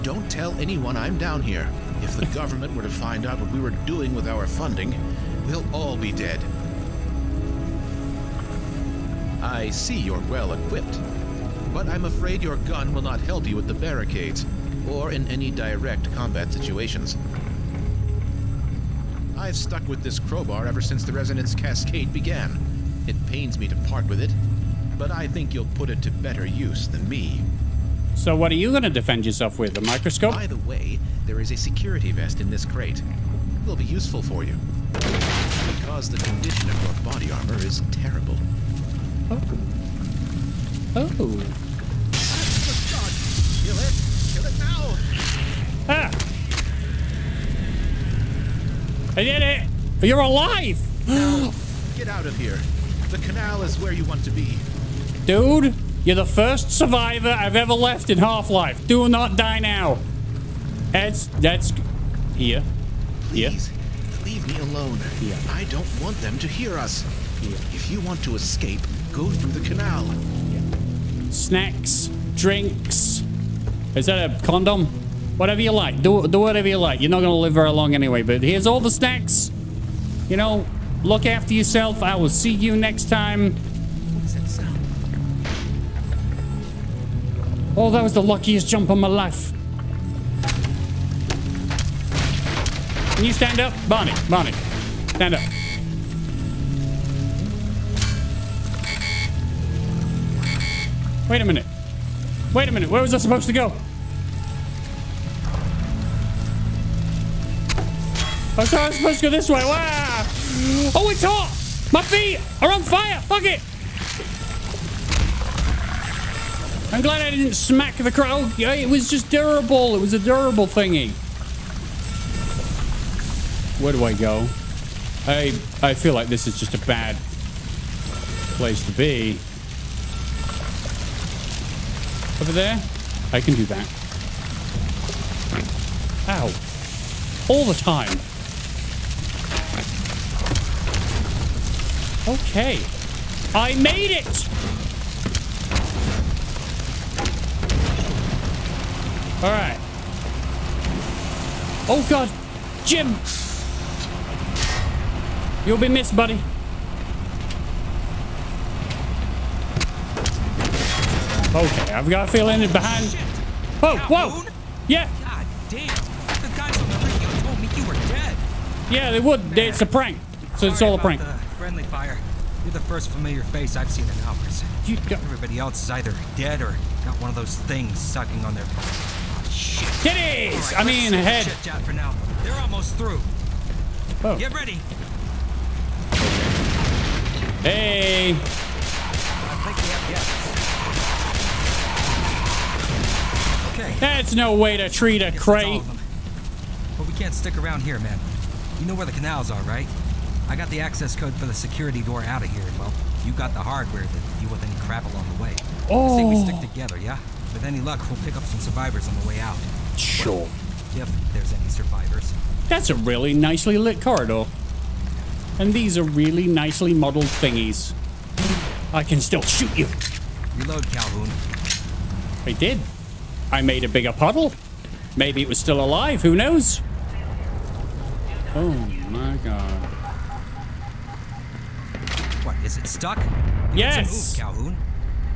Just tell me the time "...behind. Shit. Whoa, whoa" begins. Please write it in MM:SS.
02:42.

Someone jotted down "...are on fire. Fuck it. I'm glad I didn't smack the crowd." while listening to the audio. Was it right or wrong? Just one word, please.
right.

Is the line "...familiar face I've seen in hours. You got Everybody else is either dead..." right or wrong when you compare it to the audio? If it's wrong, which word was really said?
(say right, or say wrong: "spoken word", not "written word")
right.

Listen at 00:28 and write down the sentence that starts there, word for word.
So what are you going to defend yourself with, a microscope?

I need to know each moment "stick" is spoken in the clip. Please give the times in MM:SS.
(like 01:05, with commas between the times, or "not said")
03:17, 03:26.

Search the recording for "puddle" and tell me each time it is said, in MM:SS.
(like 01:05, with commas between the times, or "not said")
03:44.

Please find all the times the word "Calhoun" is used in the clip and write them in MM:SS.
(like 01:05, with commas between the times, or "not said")
03:40, 03:54.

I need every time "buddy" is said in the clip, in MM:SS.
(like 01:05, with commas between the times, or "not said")
02:36.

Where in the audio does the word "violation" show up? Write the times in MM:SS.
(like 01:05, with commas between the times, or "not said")
not said.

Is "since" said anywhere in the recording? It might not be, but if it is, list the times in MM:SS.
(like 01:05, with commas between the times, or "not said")
00:20.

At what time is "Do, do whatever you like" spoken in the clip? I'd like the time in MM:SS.
01:16.